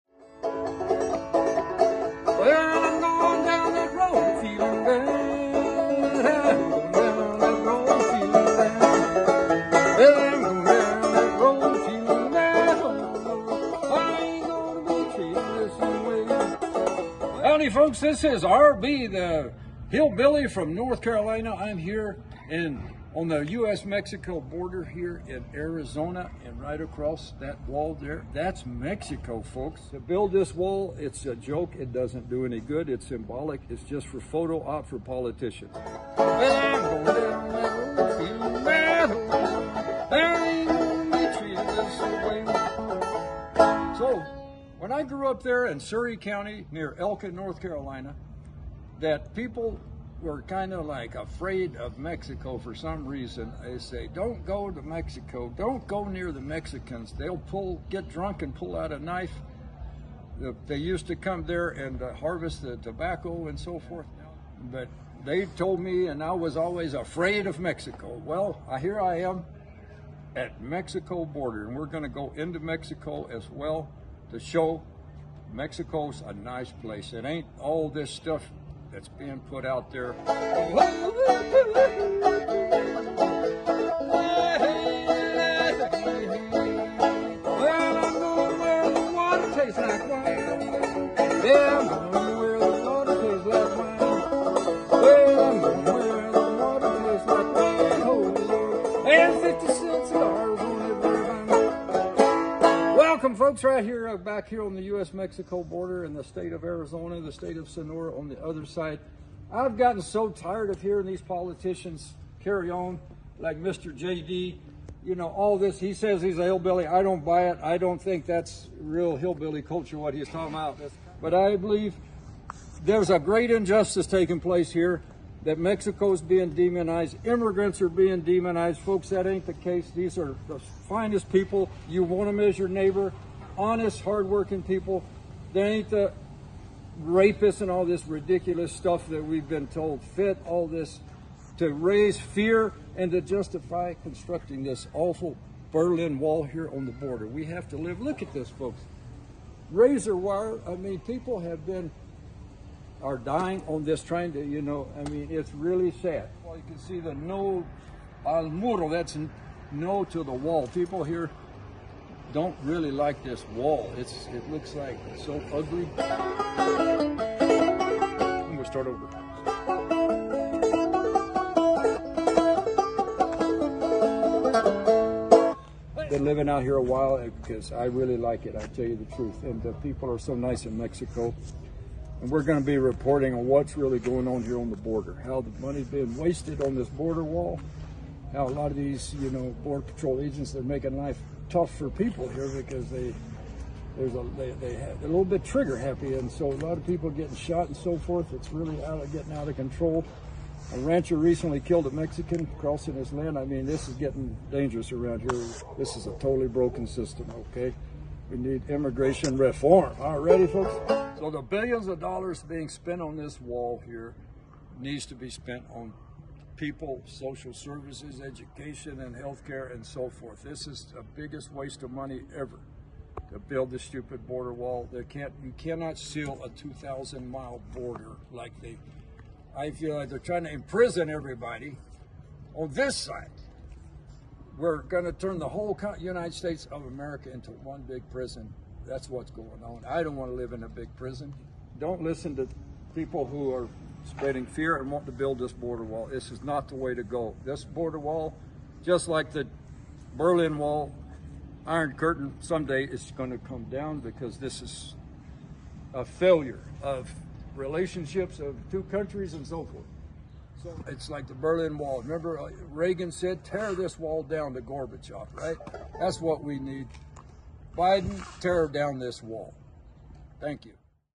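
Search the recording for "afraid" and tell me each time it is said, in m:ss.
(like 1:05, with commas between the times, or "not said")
0:51, 1:06.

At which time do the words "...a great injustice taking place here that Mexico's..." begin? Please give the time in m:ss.
2:03.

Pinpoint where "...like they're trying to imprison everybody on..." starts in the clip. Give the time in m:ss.
3:49.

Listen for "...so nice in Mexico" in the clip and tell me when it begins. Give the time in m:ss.
3:00.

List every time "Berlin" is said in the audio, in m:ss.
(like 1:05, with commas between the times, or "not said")
2:25, 4:10, 4:21.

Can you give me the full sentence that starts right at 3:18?
It's really out of getting out of control.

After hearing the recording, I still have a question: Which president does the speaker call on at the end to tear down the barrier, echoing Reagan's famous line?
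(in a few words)
Biden.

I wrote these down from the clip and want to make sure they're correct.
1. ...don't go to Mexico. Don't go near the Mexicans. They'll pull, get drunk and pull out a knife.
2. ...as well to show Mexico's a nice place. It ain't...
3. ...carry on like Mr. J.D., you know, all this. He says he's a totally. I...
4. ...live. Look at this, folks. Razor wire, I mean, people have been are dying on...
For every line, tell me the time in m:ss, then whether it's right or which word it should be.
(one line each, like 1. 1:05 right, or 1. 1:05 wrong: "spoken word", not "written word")
1. 0:54 right
2. 1:13 right
3. 1:52 wrong: "hillbilly", not "totally"
4. 2:27 right.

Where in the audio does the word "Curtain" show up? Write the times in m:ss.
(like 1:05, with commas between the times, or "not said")
4:11.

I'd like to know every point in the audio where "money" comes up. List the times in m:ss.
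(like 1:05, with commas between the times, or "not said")
3:05, 3:41.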